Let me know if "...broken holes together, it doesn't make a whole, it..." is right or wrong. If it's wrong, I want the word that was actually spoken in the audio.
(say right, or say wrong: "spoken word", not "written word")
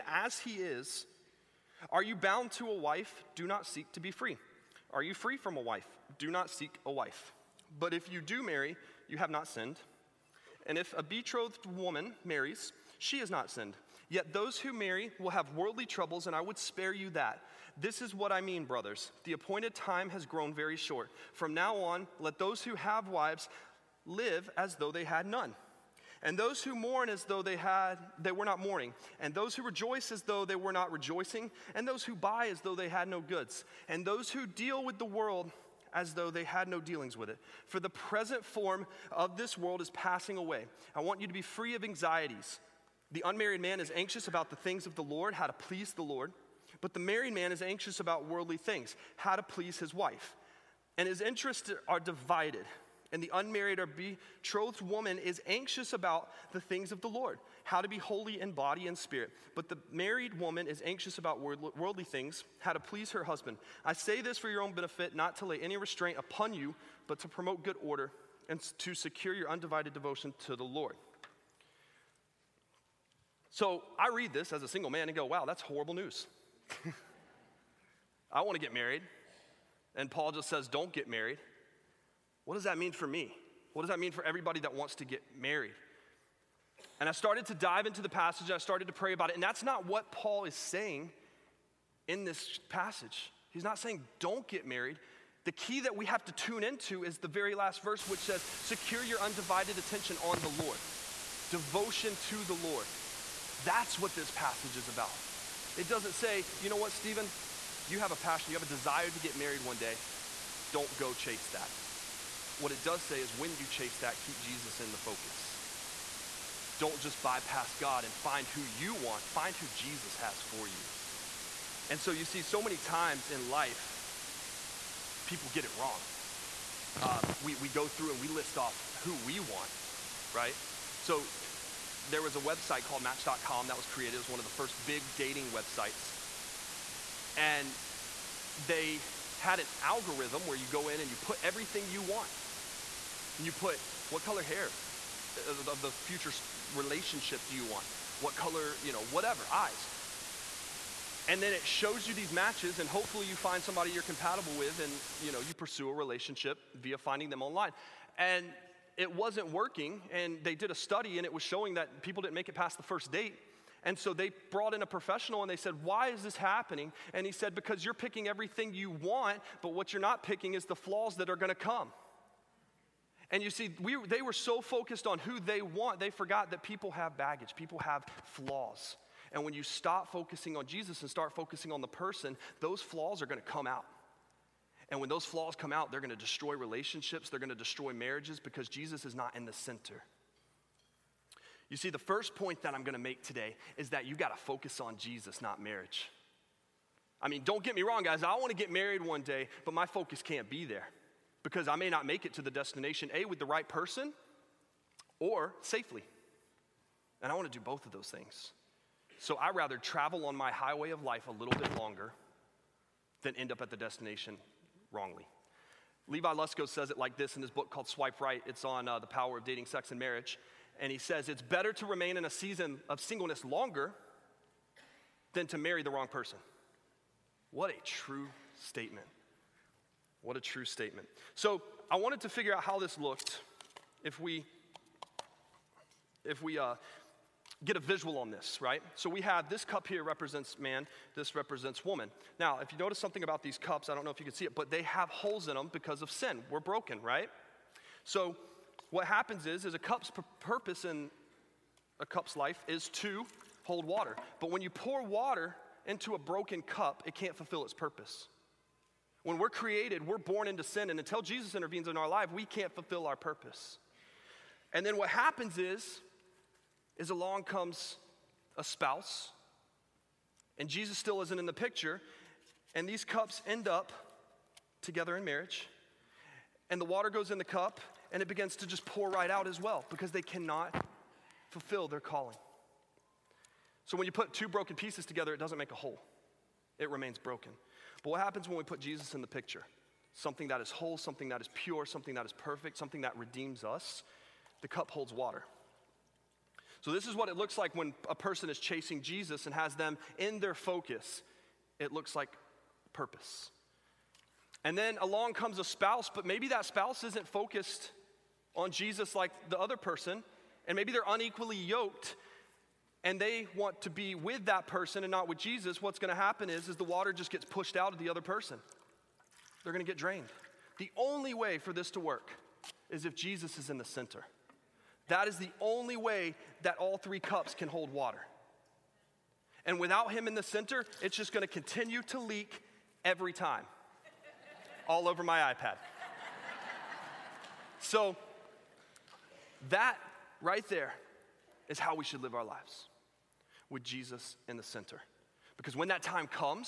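wrong: "pieces", not "holes".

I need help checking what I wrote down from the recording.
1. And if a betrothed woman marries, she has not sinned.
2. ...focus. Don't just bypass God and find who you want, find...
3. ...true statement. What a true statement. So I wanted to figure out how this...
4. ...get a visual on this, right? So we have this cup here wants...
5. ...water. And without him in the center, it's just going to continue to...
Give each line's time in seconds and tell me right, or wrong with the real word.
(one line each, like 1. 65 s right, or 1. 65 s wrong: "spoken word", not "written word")
1. 10 s right
2. 114 s right
3. 227 s right
4. 237 s wrong: "represents", not "wants"
5. 327 s right.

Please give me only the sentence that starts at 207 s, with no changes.
And I want to do both of those things.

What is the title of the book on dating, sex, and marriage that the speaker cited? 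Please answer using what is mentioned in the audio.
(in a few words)
Swipe Right.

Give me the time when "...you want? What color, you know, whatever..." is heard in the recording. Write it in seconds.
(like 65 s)
147 s.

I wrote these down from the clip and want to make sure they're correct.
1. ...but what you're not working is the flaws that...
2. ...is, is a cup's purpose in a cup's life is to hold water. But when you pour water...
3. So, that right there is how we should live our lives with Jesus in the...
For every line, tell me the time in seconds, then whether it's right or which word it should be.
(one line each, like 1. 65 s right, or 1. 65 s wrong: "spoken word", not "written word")
1. 169 s wrong: "picking", not "working"
2. 249 s right
3. 337 s right.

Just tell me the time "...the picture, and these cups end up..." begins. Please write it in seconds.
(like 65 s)
271 s.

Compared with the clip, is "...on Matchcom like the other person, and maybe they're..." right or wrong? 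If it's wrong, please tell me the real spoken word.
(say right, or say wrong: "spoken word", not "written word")
wrong: "Jesus", not "Matchcom".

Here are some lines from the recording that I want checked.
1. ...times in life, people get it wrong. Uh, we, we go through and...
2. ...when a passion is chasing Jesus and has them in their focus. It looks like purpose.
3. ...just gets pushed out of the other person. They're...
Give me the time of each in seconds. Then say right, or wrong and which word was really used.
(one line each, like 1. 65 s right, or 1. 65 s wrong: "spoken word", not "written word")
1. 122 s right
2. 297 s wrong: "person", not "passion"
3. 317 s right.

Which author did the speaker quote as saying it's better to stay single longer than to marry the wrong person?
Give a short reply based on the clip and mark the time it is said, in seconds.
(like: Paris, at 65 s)
Levi Lusko, at 216 s.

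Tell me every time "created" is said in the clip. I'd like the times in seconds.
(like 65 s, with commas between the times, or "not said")
133 s, 259 s.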